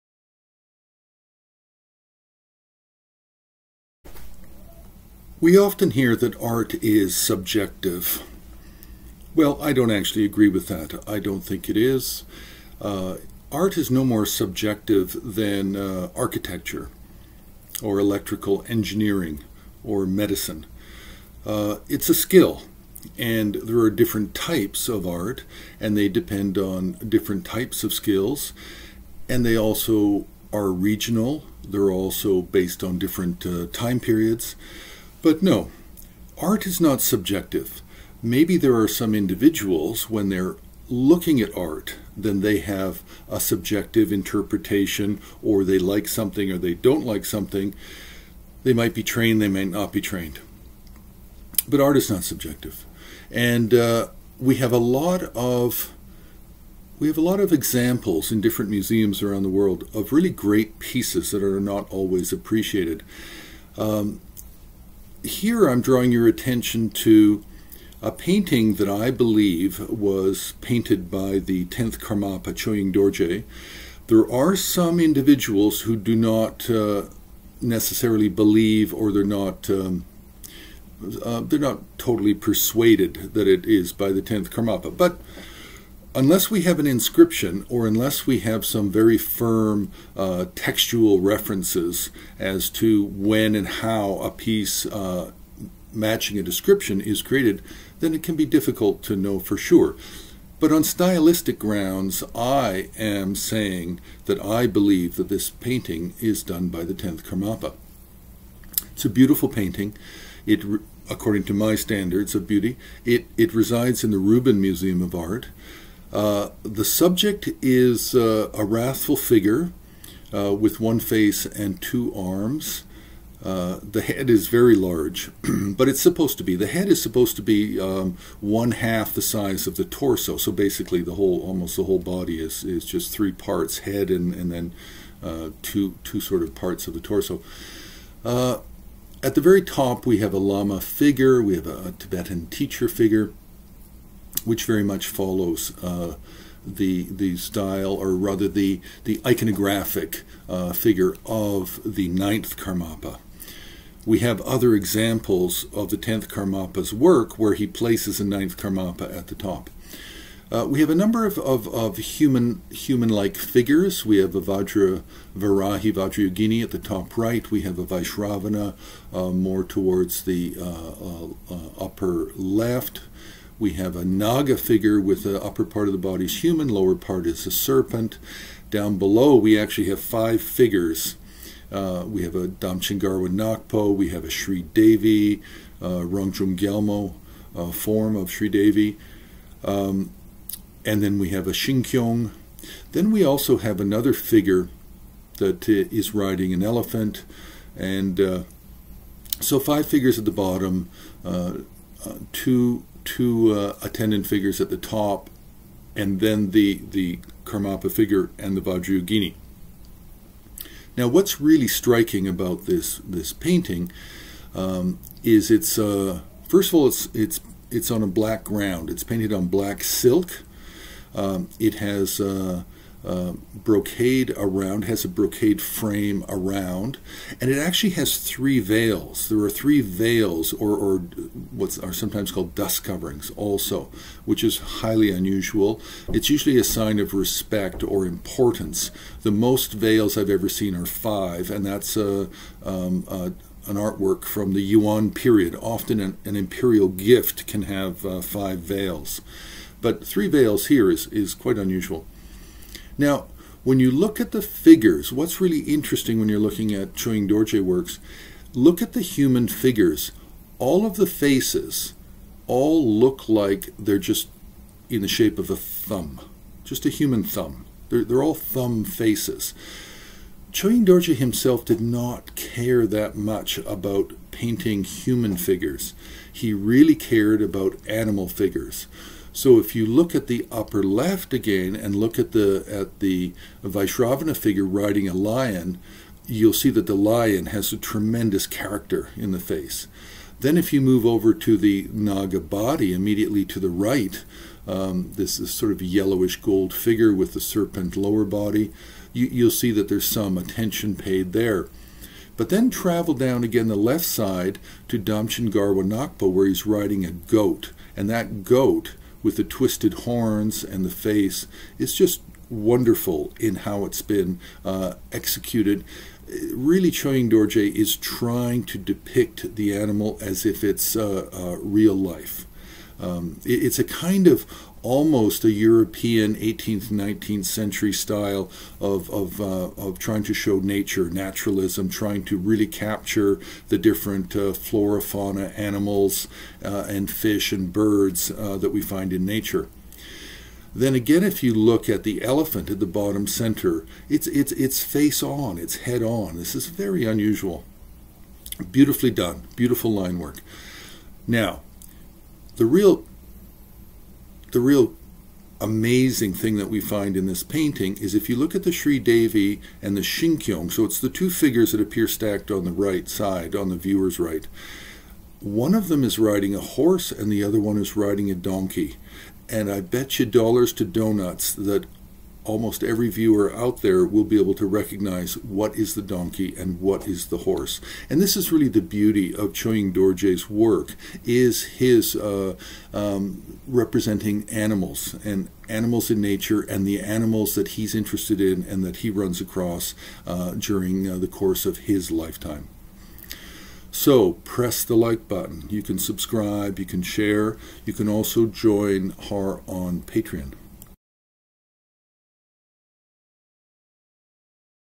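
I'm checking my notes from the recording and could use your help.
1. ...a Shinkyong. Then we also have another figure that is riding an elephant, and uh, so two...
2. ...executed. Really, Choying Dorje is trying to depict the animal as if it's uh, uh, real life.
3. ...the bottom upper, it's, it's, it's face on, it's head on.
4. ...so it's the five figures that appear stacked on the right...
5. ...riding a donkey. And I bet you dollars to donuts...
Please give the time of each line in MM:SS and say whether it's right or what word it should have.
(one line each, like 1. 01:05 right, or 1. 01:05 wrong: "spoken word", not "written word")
1. 03:11 wrong: "five", not "two"
2. 05:15 right
3. 05:42 wrong: "center", not "upper"
4. 06:00 wrong: "two", not "five"
5. 06:07 right.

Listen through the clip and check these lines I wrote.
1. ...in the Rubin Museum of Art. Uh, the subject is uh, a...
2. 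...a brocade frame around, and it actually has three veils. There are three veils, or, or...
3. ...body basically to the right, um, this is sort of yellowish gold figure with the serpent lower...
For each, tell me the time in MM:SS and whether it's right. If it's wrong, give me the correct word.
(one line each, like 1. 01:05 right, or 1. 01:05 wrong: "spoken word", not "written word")
1. 01:54 right
2. 03:45 right
3. 04:52 wrong: "immediately", not "basically".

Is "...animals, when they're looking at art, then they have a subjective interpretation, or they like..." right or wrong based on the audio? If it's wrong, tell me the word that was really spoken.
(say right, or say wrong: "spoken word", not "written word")
wrong: "individuals", not "animals".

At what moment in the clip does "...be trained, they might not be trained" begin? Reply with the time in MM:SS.
00:48.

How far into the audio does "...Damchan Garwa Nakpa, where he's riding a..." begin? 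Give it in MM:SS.
05:04.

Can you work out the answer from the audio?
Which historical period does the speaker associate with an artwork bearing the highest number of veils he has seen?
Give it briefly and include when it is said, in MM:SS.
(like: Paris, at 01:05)
Yuan period, at 04:04.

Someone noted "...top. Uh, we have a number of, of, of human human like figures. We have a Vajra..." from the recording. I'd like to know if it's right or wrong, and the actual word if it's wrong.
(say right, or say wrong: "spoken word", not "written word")
right.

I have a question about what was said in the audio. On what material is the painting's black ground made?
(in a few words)
Black silk.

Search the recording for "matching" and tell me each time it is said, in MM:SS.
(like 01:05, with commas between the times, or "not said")
01:35.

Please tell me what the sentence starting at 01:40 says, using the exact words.
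But on stylistic grounds, I am saying that I believe that this painting is done by the 10th Karmapa.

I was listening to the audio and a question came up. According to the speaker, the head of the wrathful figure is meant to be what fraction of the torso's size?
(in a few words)
One half.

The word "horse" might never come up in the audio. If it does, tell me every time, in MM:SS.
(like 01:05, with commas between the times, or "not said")
06:06, 06:17.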